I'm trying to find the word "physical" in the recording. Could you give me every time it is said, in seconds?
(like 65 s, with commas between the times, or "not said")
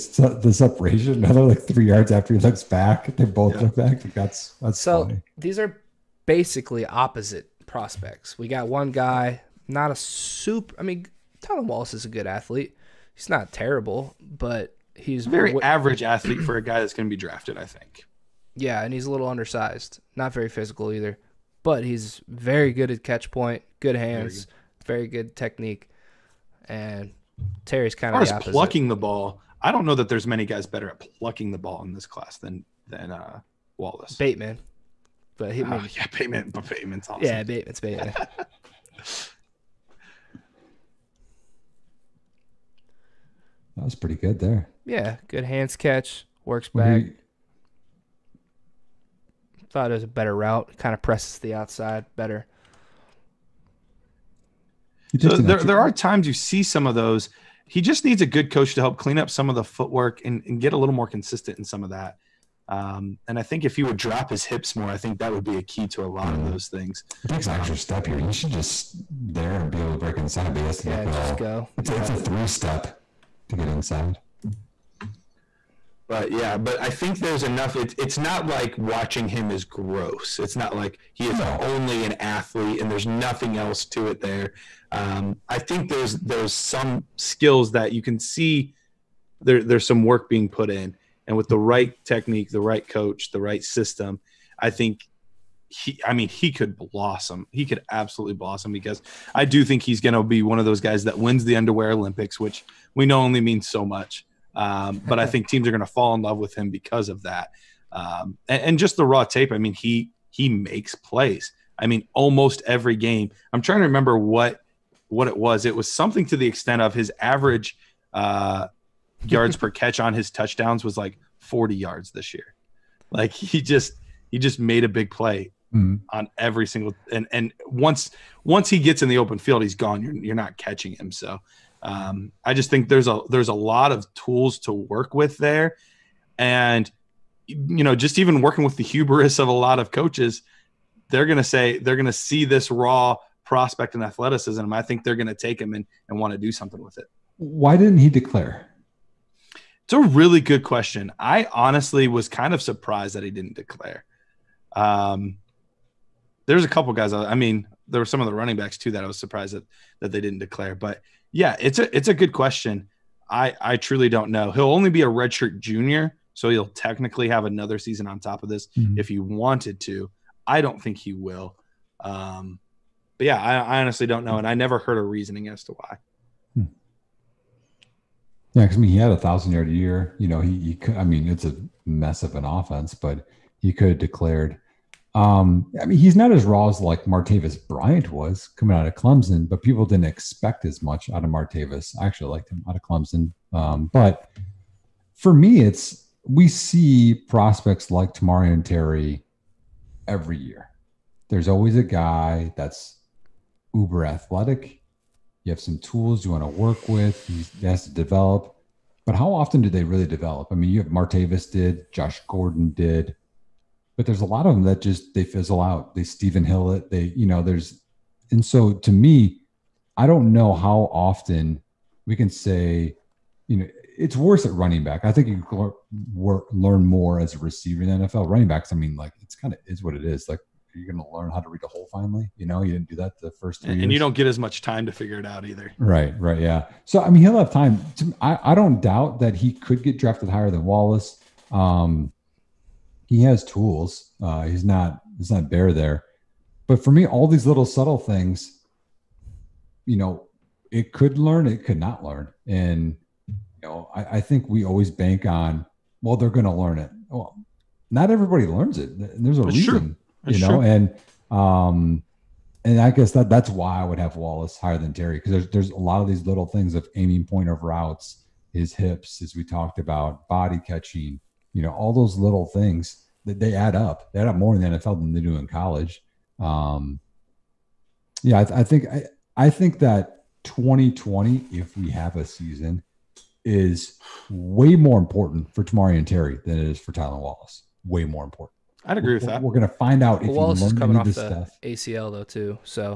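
20 s.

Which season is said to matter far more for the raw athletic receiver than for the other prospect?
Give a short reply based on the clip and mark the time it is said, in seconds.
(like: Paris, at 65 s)
2020, at 280 s.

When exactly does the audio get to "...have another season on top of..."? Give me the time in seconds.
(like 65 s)
167 s.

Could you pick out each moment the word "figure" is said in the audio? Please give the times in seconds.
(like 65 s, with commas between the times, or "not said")
234 s.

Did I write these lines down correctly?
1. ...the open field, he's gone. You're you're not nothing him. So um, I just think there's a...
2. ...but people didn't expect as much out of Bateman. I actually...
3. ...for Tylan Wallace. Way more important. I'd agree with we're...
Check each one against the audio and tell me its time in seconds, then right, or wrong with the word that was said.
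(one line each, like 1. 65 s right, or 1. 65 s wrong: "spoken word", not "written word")
1. 129 s wrong: "catching", not "nothing"
2. 189 s wrong: "Martavis", not "Bateman"
3. 286 s right.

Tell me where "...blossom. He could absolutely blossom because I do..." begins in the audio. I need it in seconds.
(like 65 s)
96 s.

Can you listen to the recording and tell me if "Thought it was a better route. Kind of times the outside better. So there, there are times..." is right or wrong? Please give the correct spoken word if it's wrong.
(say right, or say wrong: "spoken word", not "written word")
wrong: "presses", not "times".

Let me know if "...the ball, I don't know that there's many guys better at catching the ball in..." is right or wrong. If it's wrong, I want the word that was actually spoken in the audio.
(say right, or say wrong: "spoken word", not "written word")
wrong: "plucking", not "catching".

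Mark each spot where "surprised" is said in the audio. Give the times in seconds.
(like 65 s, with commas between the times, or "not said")
152 s, 159 s.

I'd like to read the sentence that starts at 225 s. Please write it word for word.
I think you work, learn more as a receiver in the NFL.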